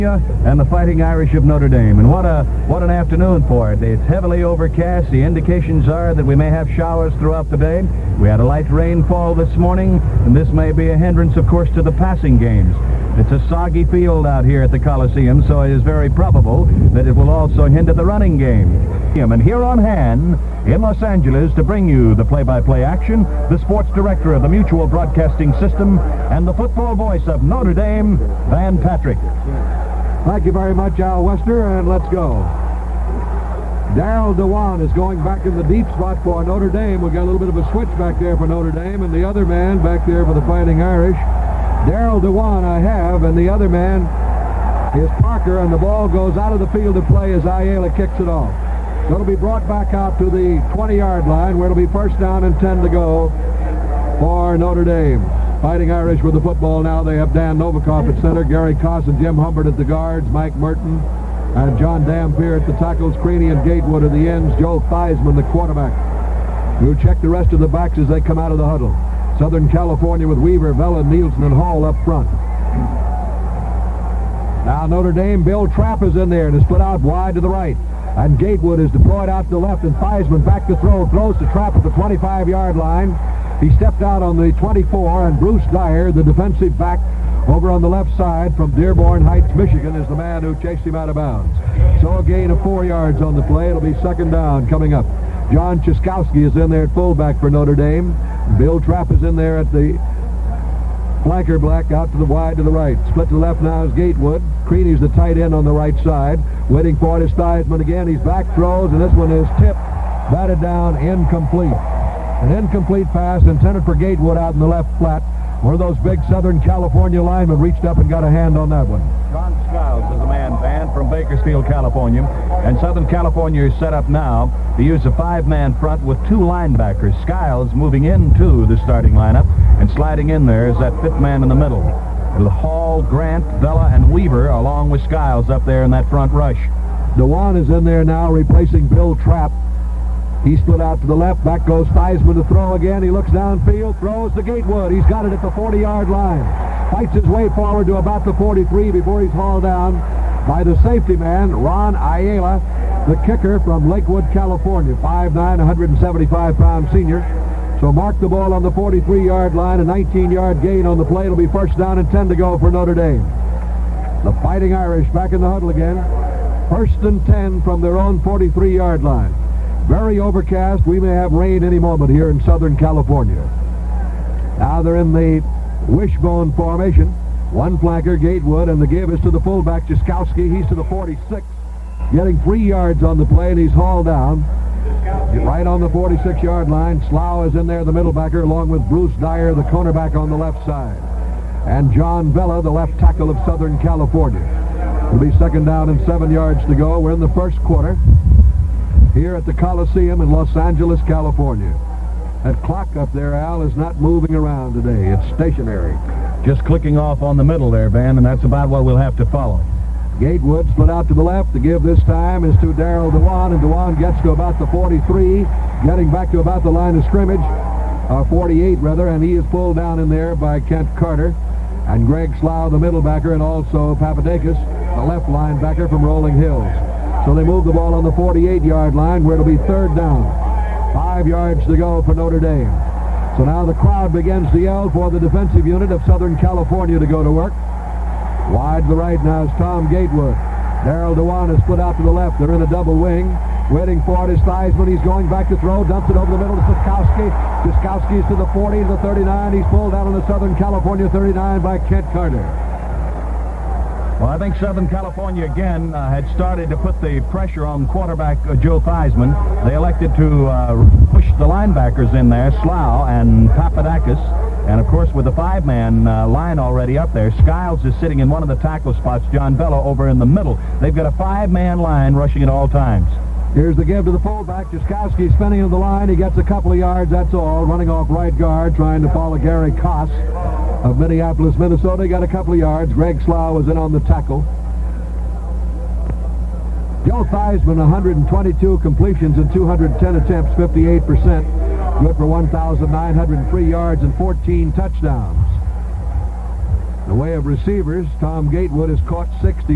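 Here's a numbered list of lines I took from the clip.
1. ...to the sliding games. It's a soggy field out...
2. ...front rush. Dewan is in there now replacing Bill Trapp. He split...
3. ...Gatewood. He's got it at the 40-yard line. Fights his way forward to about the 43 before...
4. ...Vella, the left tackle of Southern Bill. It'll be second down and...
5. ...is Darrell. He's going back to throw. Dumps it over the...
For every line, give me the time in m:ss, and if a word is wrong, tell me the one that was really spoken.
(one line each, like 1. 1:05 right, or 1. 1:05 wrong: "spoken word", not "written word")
1. 0:11 wrong: "passing", not "sliding"
2. 2:16 right
3. 2:24 right
4. 3:12 wrong: "California", not "Bill"
5. 4:04 wrong: "Theismann", not "Darrell".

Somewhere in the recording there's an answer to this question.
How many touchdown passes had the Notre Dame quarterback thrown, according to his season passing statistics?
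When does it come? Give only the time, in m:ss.
4:54.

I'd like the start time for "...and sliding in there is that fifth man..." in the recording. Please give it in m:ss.
2:09.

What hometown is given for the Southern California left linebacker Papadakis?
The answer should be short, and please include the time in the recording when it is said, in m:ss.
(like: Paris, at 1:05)
Rolling Hills, at 3:46.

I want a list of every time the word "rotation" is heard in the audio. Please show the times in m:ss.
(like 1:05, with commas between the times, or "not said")
not said.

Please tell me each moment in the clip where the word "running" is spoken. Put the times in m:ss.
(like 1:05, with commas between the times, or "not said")
0:18, 4:37.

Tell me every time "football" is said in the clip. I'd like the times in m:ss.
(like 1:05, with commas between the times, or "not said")
0:26, 0:56.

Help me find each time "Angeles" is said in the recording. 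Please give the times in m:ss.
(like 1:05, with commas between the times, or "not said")
0:20, 3:20.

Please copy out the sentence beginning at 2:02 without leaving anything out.
And Southern California is set up now to use a five-man front with two linebackers.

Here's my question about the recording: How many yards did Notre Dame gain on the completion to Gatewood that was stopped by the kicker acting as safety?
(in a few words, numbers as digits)
19.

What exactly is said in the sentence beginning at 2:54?
Now they're in the wishbone formation.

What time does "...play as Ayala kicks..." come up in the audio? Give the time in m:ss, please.
0:47.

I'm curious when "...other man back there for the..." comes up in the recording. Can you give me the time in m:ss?
0:39.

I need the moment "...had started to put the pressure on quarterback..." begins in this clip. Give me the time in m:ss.
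4:16.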